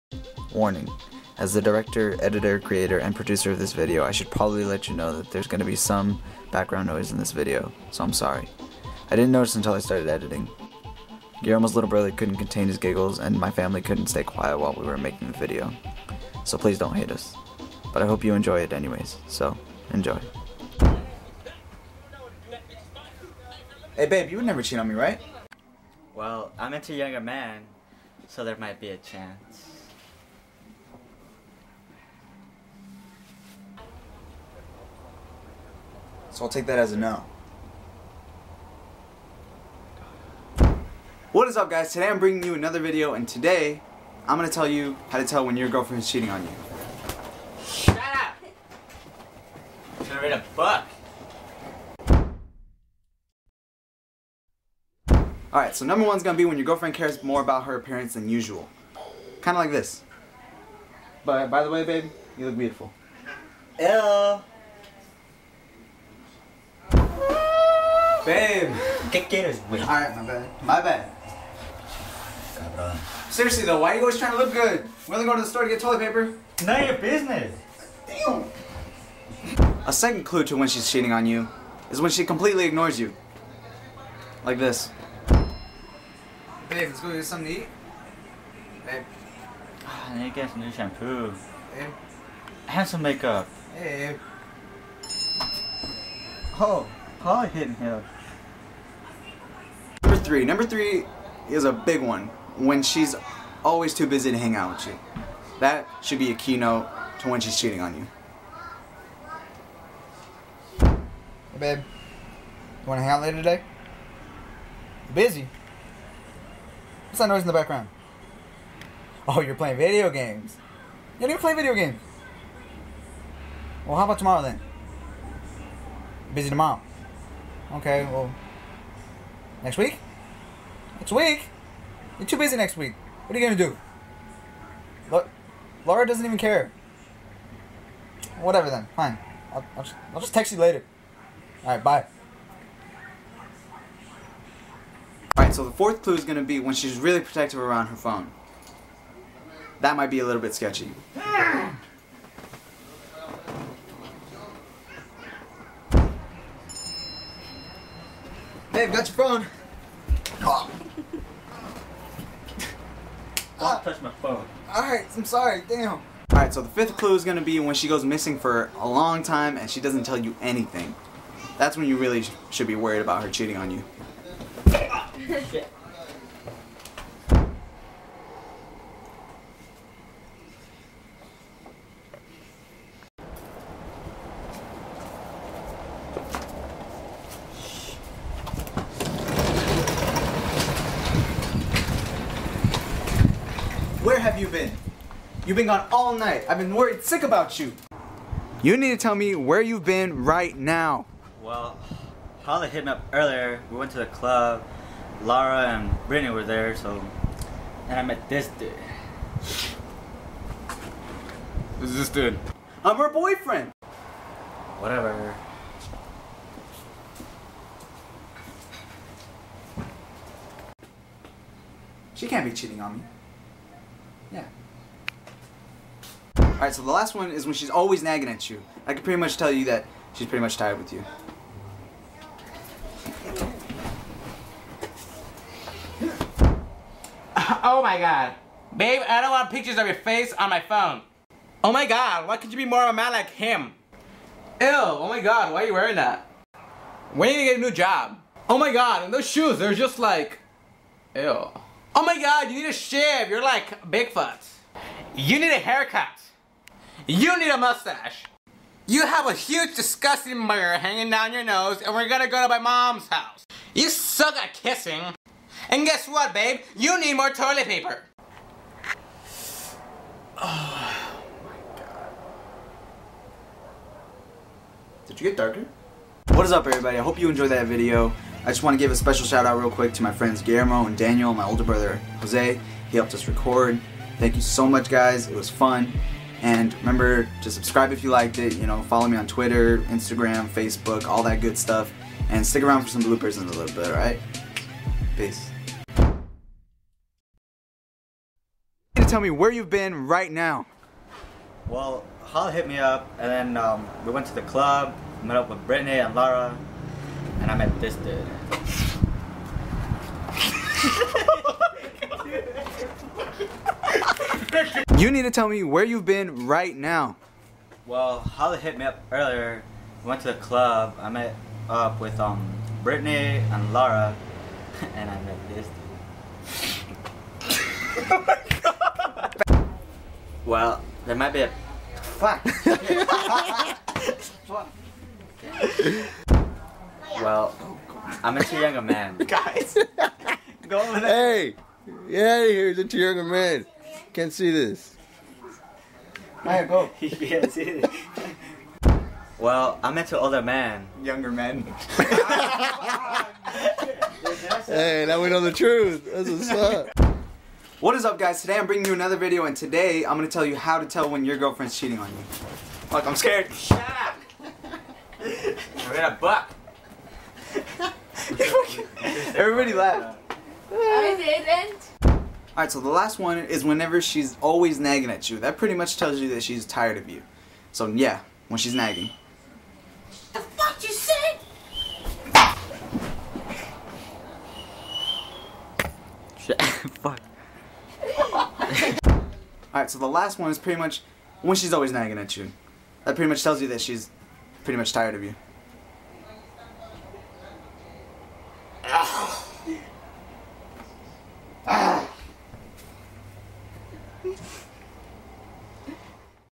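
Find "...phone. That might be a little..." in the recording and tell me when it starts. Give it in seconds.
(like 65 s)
147 s.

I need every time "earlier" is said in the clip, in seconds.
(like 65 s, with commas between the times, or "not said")
203 s, 319 s.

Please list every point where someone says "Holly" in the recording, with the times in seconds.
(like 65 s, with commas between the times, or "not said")
202 s, 318 s.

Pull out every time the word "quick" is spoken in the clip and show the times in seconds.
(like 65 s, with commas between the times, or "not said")
279 s.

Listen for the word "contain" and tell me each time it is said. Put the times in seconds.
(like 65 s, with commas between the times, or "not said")
12 s.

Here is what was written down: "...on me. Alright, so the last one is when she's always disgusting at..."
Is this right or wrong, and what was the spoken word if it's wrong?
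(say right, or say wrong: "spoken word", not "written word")
wrong: "nagging", not "disgusting".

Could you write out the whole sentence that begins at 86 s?
Babe, let's go get something to eat.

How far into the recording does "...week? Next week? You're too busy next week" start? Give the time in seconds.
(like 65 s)
129 s.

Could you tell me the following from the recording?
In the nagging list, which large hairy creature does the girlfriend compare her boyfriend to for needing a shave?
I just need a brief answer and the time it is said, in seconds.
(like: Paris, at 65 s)
Bigfoot, at 253 s.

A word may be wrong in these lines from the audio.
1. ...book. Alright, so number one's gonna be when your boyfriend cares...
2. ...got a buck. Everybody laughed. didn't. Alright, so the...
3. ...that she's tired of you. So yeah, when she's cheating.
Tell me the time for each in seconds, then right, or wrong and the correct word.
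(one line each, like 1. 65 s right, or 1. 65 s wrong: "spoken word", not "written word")
1. 50 s wrong: "girlfriend", not "boyfriend"
2. 365 s right
3. 376 s wrong: "nagging", not "cheating".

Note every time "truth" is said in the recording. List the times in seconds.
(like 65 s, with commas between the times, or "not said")
355 s.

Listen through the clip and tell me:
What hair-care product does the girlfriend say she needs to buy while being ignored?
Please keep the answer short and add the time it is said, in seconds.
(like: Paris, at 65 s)
shampoo, at 90 s.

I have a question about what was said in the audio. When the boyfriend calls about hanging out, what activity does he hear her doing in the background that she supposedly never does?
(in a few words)
playing video games.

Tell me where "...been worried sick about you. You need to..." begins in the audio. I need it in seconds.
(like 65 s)
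196 s.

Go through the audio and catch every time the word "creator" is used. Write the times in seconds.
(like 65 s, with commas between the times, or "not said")
2 s.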